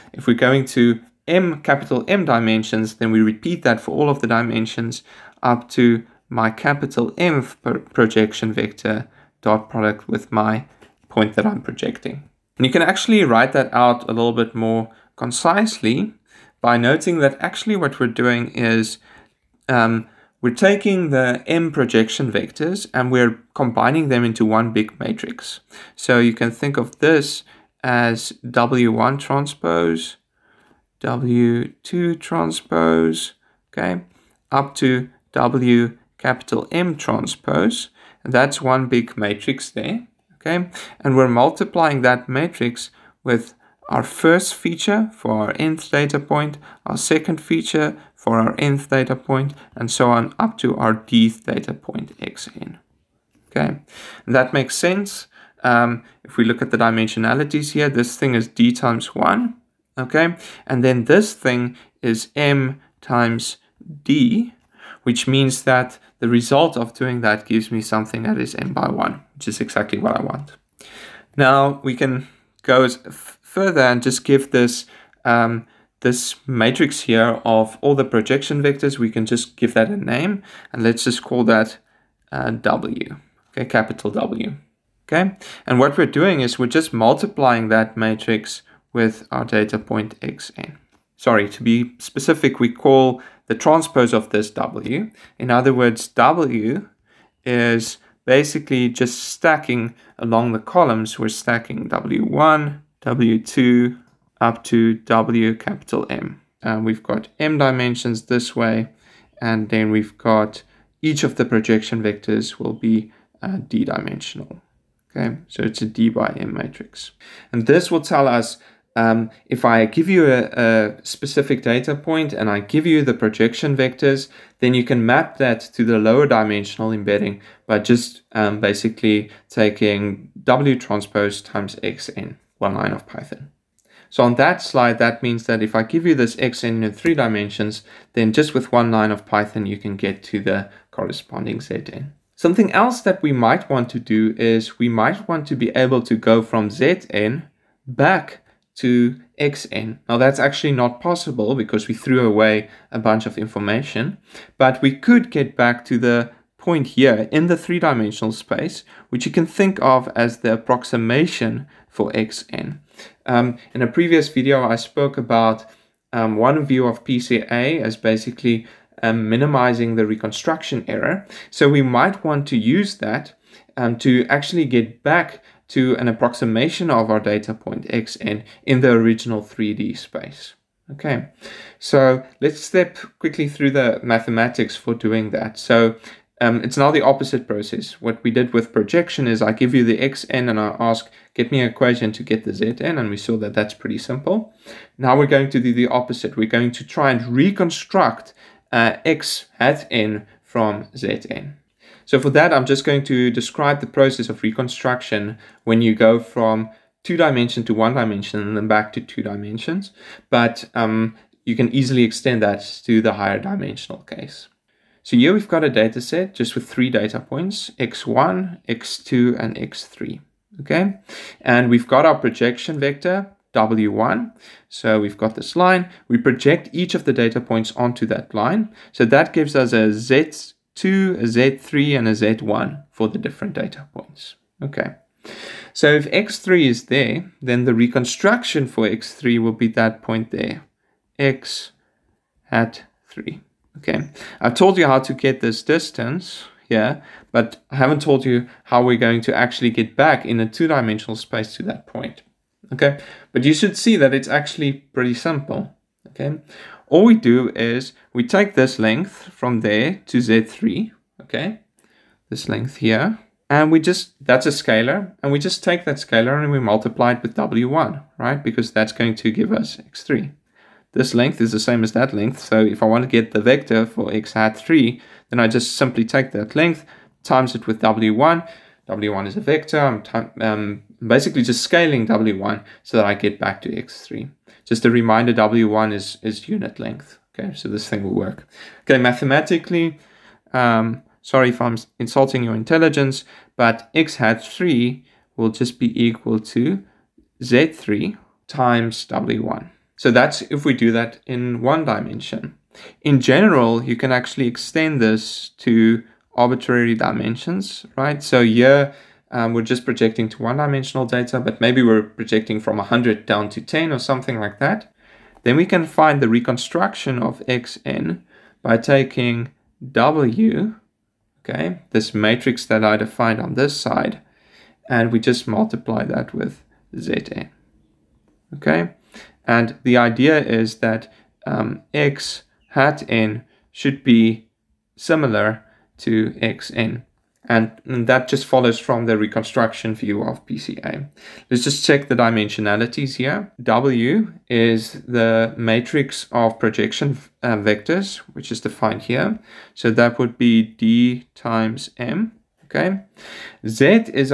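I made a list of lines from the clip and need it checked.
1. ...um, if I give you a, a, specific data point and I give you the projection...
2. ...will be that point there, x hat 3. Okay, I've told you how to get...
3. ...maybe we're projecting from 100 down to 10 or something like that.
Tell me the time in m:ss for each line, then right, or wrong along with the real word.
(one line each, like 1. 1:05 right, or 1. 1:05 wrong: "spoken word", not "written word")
1. 1:58 right
2. 3:59 right
3. 5:11 right.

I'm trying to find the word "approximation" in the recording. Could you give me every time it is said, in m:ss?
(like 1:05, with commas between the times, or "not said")
2:40, 2:56.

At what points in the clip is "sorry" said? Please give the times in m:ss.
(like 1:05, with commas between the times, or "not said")
1:31, 4:51.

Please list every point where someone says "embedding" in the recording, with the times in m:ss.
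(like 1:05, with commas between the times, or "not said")
2:06.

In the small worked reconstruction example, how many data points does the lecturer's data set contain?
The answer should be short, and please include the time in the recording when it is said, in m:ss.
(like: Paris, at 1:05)
3, at 3:36.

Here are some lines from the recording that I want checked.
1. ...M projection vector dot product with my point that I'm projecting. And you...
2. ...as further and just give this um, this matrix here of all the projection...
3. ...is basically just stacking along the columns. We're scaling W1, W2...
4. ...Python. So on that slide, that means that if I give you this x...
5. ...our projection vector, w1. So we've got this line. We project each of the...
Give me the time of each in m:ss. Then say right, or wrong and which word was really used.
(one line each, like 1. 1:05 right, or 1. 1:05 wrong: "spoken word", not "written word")
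1. 0:07 right
2. 1:12 right
3. 1:37 wrong: "stacking", not "scaling"
4. 2:13 right
5. 3:42 right.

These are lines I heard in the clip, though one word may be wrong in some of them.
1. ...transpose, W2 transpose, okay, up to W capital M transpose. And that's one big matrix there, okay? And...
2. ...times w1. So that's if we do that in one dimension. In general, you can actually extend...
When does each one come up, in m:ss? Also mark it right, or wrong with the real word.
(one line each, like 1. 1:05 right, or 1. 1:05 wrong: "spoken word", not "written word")
1. 0:29 right
2. 4:58 right.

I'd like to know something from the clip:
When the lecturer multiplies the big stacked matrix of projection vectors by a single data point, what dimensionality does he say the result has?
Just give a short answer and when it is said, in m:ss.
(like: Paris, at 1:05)
m by 1, at 1:08.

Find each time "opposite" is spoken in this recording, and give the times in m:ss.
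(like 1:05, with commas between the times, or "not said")
3:07, 3:15.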